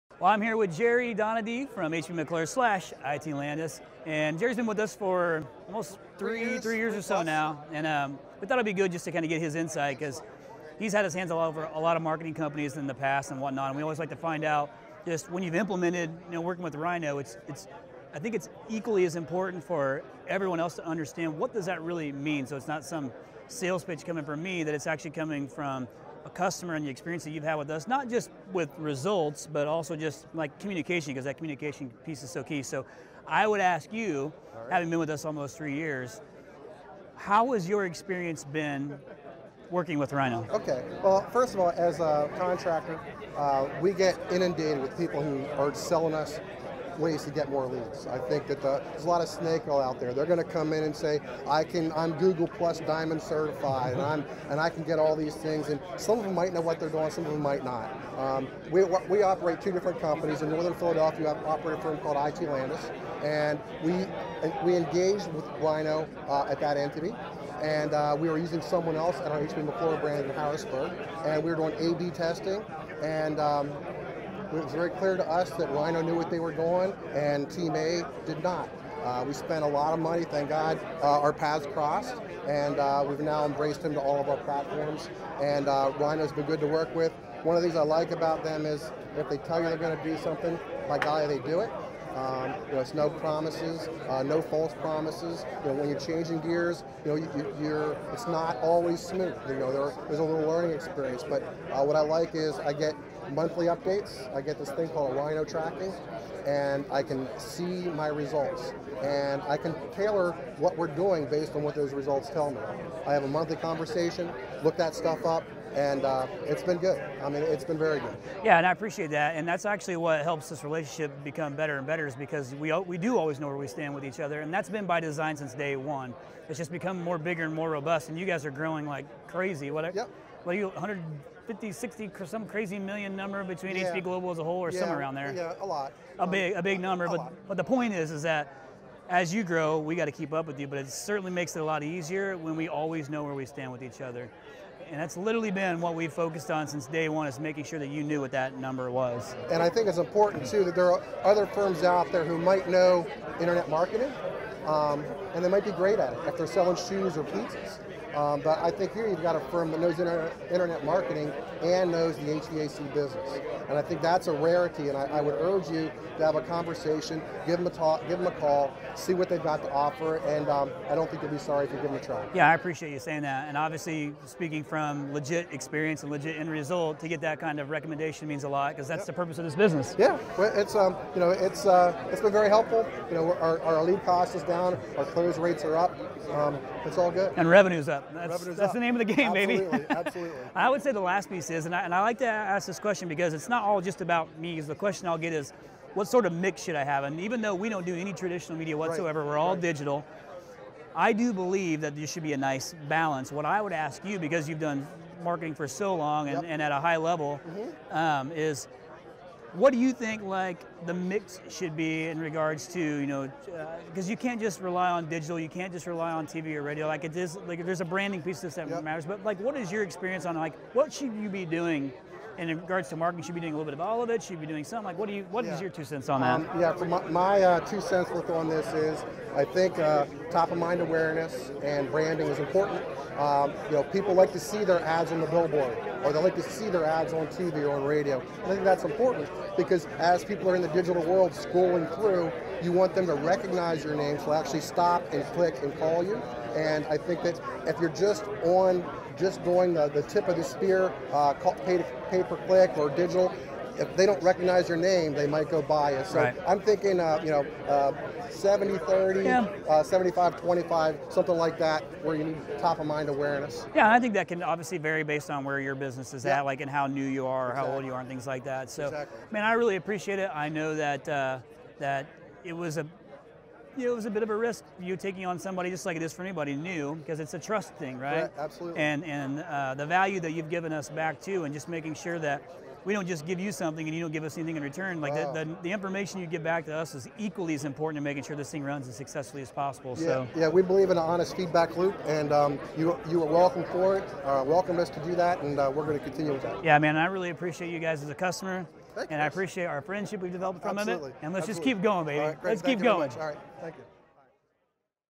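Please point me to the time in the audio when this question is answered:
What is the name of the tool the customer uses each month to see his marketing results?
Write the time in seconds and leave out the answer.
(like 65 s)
105 s.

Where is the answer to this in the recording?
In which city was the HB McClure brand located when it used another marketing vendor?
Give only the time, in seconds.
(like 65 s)
70 s.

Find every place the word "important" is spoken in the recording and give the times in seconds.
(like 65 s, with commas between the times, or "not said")
19 s, 149 s, 232 s, 238 s, 287 s.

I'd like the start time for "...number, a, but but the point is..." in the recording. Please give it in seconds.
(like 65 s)
136 s.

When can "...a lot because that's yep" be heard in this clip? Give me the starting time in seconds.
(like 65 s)
178 s.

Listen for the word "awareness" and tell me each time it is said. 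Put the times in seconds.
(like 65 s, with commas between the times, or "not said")
230 s, 263 s.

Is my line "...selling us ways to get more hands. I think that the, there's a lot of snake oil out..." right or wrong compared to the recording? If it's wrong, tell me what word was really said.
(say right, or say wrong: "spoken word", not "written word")
wrong: "leads", not "hands".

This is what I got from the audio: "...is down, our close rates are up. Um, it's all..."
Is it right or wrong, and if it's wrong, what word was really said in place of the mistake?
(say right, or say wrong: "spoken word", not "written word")
right.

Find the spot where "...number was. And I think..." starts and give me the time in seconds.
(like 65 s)
148 s.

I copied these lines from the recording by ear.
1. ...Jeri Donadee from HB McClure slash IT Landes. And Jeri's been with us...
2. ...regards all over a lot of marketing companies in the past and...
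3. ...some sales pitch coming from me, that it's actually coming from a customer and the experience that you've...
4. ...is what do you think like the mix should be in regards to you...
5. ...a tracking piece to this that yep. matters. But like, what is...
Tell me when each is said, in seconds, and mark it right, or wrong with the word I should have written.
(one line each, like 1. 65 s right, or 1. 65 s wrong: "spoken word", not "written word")
1. 0 s right
2. 11 s wrong: "hands", not "regards"
3. 22 s right
4. 208 s right
5. 217 s wrong: "branding", not "tracking".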